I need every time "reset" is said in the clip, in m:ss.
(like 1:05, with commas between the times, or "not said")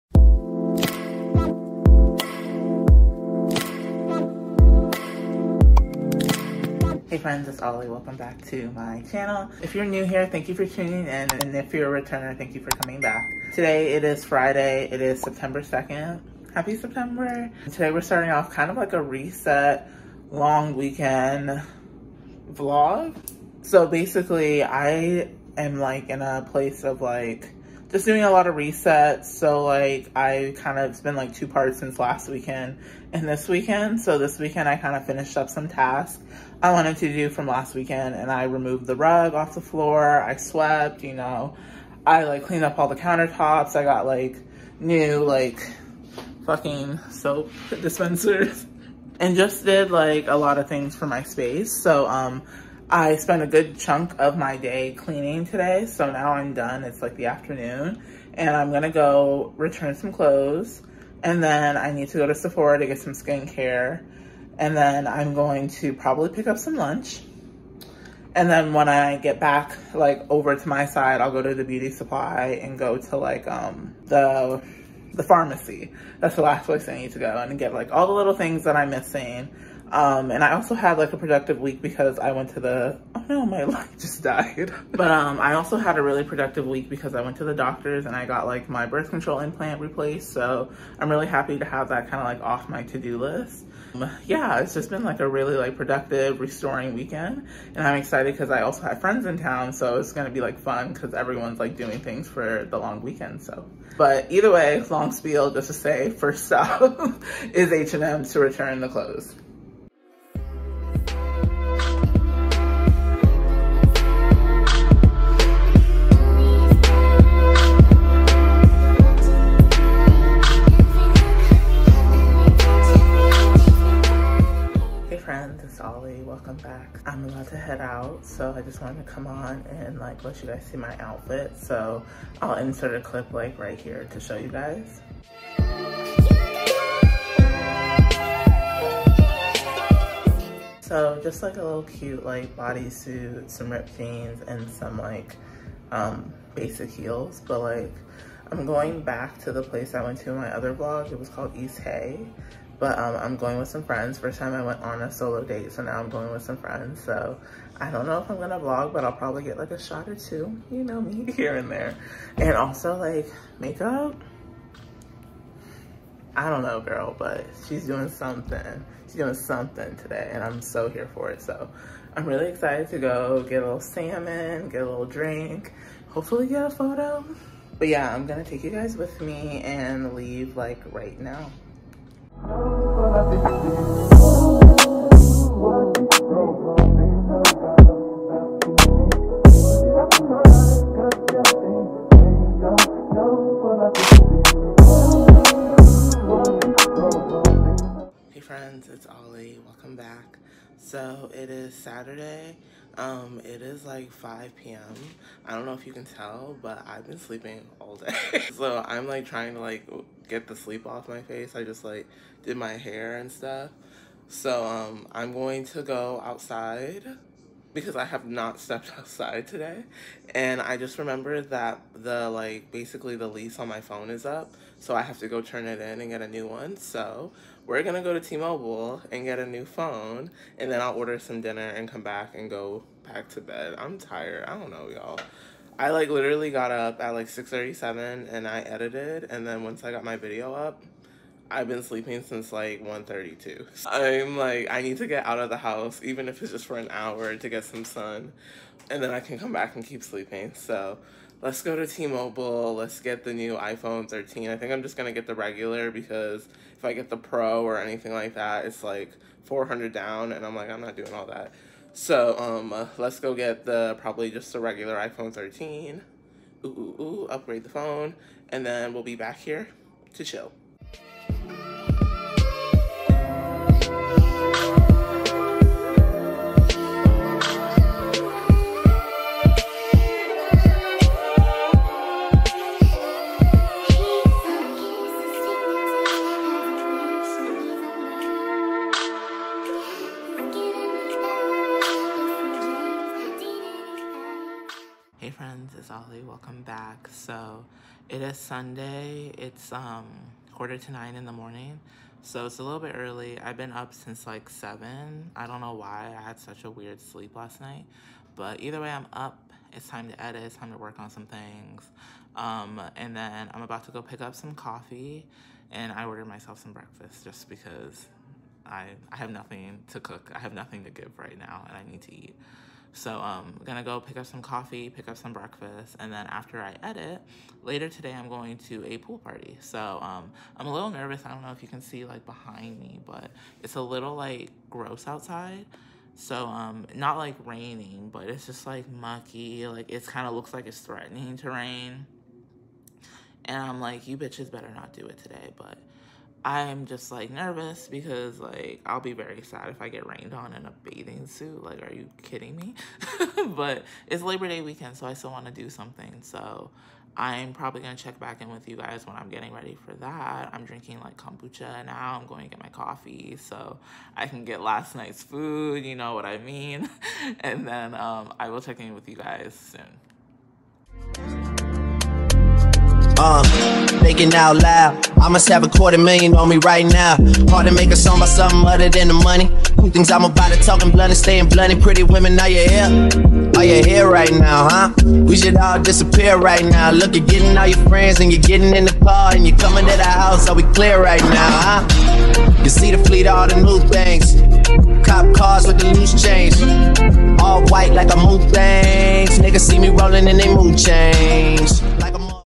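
0:19, 0:28.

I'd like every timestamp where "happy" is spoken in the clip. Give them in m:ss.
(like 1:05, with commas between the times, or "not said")
0:16, 1:31.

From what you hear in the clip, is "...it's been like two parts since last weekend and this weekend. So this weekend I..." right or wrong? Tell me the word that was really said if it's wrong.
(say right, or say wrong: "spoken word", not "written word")
right.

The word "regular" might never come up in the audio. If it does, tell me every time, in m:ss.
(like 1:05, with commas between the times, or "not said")
4:15, 4:24.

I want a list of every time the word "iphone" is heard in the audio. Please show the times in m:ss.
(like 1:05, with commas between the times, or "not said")
4:13, 4:24.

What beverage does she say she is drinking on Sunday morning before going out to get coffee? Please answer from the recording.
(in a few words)
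kombucha.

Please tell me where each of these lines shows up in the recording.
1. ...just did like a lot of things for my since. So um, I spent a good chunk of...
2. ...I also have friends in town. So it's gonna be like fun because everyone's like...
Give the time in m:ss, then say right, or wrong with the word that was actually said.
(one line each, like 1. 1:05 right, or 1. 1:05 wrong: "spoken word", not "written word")
1. 0:49 wrong: "space", not "since"
2. 1:38 right.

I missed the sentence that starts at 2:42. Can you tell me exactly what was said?
And also like makeup, I don't know, girl, but she's doing something.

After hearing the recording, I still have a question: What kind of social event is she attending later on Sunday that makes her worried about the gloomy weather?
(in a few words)
pool party.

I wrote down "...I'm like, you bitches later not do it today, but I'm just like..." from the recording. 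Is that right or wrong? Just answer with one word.
wrong.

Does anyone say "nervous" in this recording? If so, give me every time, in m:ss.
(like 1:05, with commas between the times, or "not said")
5:30, 5:47.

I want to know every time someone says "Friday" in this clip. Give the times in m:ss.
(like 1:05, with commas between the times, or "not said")
0:14.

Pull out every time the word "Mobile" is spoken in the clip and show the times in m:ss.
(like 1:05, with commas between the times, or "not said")
3:48, 4:11.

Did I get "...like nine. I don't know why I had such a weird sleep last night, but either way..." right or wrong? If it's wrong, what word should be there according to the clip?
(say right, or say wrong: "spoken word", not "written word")
wrong: "seven", not "nine".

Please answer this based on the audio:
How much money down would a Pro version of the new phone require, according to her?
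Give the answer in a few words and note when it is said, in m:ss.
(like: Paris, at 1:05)
400, at 4:19.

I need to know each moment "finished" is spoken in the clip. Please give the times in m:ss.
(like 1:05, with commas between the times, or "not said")
0:35.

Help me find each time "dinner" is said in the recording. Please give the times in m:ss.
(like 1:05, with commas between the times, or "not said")
3:51.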